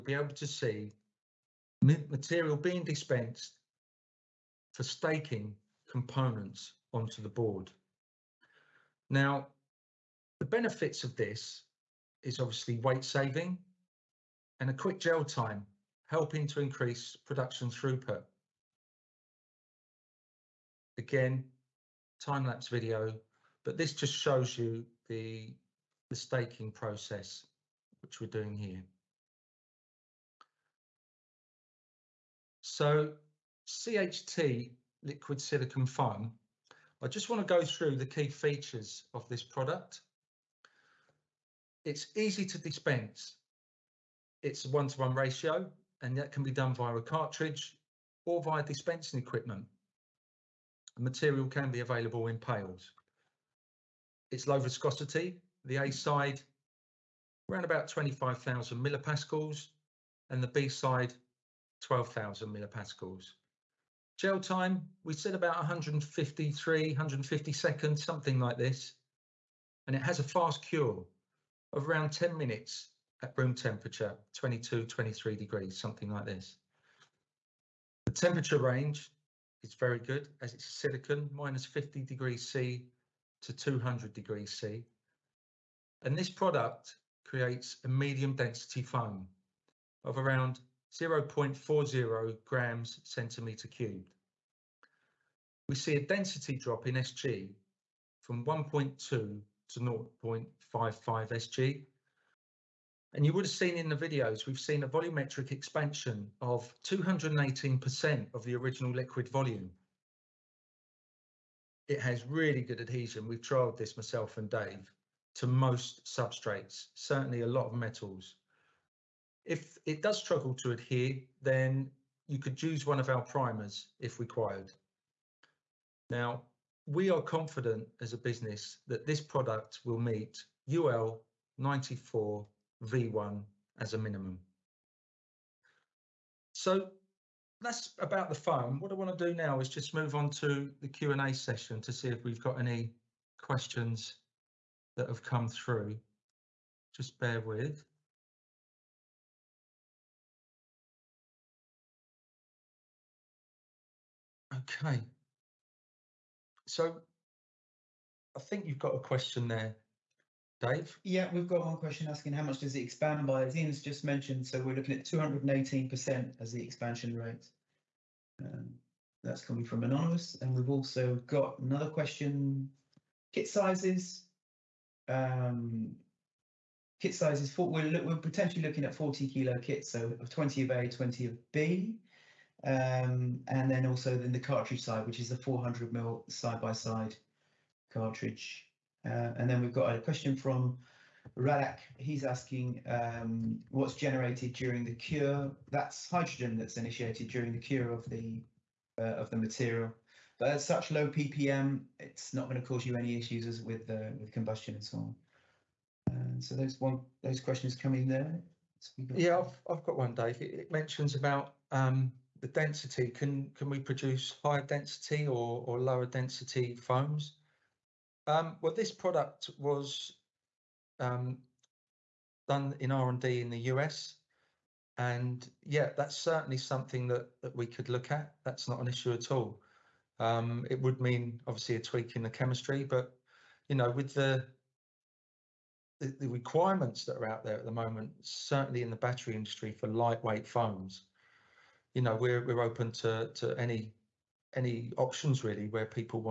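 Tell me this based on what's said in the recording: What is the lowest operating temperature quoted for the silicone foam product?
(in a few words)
-50°C.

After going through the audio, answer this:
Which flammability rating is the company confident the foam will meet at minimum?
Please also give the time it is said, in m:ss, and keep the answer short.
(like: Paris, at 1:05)
UL 94 V1, at 2:10.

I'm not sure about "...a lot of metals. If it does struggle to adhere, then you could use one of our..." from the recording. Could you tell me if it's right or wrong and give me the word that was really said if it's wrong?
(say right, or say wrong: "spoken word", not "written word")
right.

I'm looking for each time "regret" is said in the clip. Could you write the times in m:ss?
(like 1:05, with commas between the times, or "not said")
not said.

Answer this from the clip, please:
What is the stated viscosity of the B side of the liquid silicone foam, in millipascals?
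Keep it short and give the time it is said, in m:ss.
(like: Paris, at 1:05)
12,000 millipascals, at 1:01.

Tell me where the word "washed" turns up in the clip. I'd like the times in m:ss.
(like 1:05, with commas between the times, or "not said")
not said.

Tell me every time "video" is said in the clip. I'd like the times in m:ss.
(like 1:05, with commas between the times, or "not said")
0:22, 1:43.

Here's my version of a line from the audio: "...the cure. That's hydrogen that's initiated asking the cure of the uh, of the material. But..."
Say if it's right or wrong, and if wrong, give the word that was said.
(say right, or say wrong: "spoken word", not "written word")
wrong: "during", not "asking".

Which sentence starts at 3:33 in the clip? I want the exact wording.
Can can we produce higher density or, or lower density foams?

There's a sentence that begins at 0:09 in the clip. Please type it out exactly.
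Now, the benefits of this is obviously weight saving and a quick gel time, helping to increase production throughput.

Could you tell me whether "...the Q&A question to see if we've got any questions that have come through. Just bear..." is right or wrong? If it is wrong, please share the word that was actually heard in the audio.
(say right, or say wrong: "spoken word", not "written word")
wrong: "session", not "question".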